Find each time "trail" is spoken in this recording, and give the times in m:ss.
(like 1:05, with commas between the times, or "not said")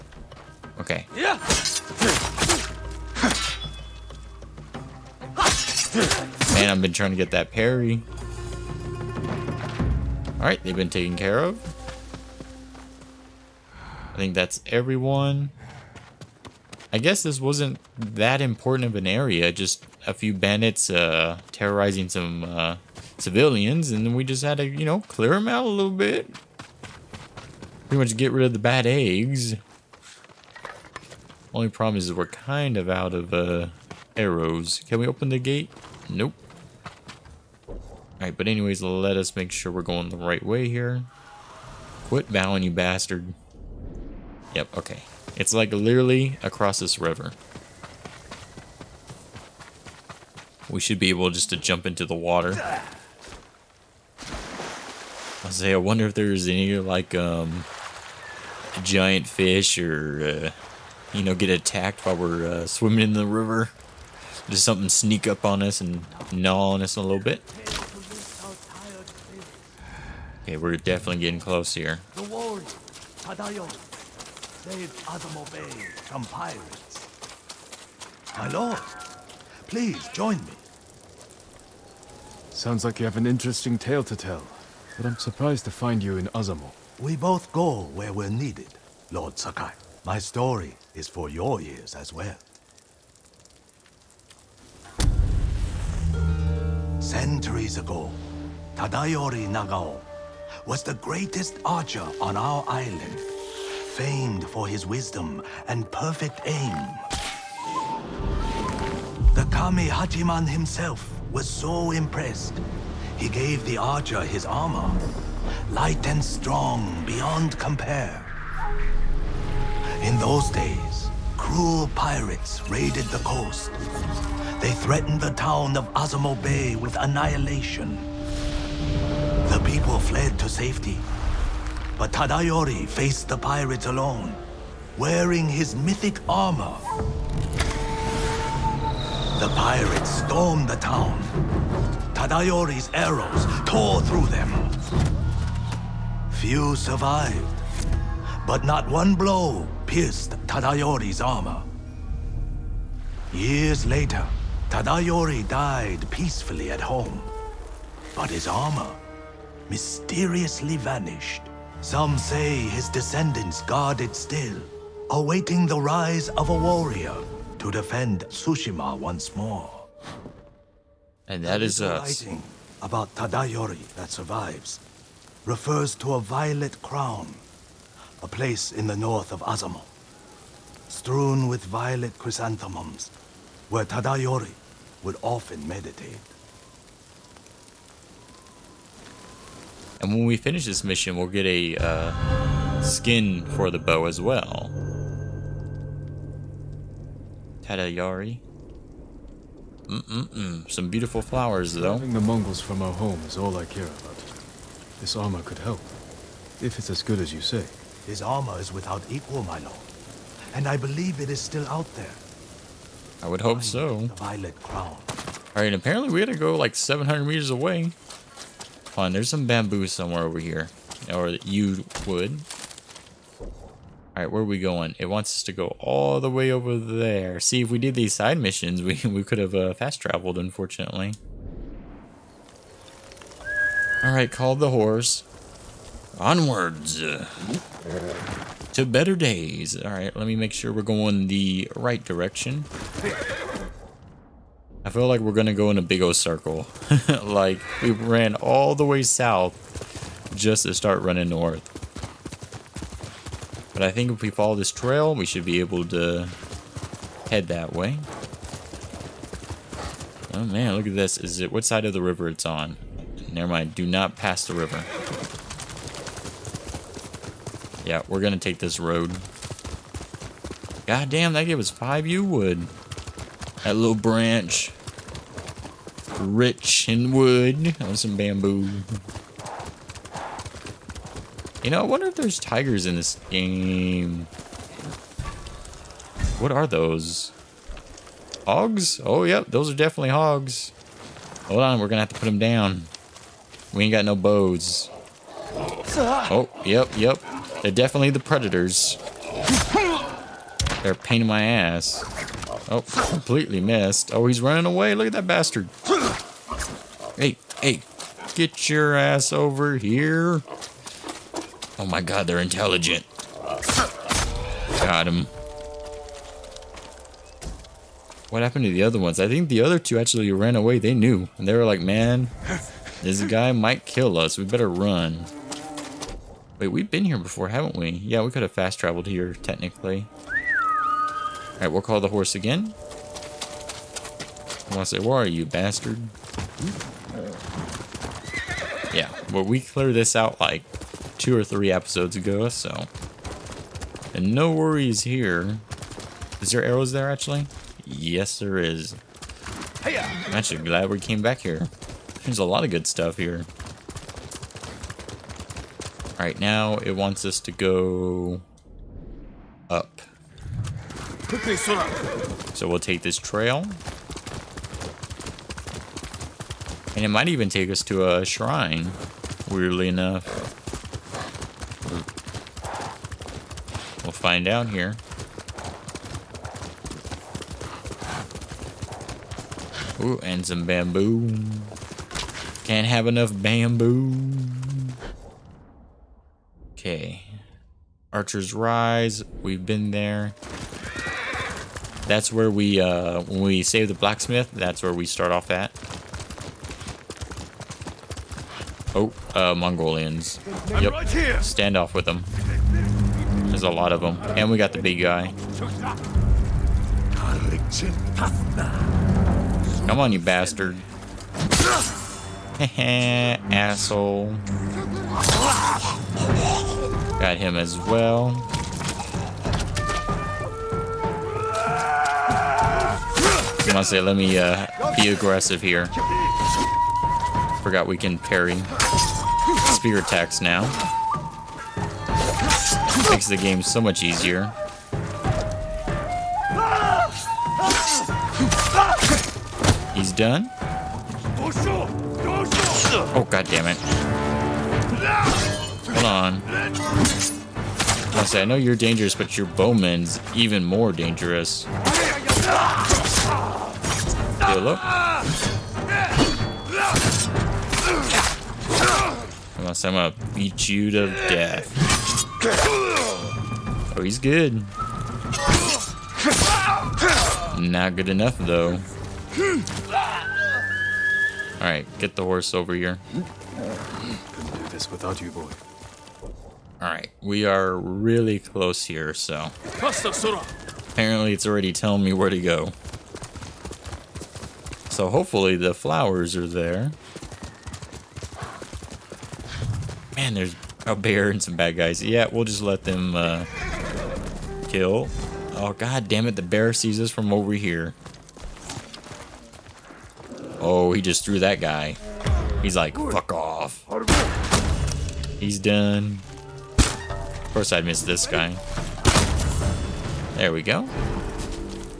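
4:14, 6:03.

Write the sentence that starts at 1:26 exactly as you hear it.
We both go where we're needed, Lord Sakai.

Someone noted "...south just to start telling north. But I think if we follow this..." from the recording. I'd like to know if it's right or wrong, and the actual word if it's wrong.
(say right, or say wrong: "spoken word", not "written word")
wrong: "running", not "telling".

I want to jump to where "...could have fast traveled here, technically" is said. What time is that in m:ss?
5:28.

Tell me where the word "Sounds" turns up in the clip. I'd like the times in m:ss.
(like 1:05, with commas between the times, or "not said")
1:22.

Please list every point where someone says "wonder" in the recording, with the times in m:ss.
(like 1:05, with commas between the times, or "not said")
0:55, 4:41.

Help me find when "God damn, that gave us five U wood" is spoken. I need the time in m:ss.
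4:30.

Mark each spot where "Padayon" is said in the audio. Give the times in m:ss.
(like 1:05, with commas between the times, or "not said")
1:13.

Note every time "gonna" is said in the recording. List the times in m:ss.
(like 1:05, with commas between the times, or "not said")
4:05, 4:28, 4:51, 7:39.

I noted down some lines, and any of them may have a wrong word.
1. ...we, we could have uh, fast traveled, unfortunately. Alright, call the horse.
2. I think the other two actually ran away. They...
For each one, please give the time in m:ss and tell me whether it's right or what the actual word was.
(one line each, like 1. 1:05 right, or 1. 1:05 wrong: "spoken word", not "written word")
1. 3:48 right
2. 5:19 right.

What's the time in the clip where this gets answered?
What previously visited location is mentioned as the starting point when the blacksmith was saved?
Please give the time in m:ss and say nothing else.
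6:28.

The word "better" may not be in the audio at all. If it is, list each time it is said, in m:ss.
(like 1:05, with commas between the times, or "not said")
3:58, 5:24.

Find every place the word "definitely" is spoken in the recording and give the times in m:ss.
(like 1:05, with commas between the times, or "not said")
1:10, 4:49, 4:57.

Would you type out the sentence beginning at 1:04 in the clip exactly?
Does something sneak up on us and gnaw on us a little bit.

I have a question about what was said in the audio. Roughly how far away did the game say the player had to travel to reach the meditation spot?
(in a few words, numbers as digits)
700 meters.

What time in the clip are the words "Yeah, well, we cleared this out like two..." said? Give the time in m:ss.
5:38.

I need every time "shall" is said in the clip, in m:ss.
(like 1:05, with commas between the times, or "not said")
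not said.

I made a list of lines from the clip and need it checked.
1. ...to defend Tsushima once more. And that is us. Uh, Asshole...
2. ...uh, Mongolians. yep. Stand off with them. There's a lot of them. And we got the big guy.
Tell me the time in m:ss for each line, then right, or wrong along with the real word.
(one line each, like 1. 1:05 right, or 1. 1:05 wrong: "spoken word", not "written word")
1. 2:47 wrong: "Writing", not "Asshole"
2. 6:39 right.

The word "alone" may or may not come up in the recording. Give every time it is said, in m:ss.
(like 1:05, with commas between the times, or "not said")
2:13.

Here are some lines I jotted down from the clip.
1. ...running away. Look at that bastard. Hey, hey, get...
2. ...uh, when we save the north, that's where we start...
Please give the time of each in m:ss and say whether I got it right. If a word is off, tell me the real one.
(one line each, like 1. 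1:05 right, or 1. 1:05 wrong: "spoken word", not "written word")
1. 5:04 right
2. 6:32 wrong: "blacksmith", not "north".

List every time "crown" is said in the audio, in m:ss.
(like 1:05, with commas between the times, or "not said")
2:56, 3:34.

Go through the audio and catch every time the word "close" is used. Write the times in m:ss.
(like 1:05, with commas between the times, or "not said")
1:11, 7:58.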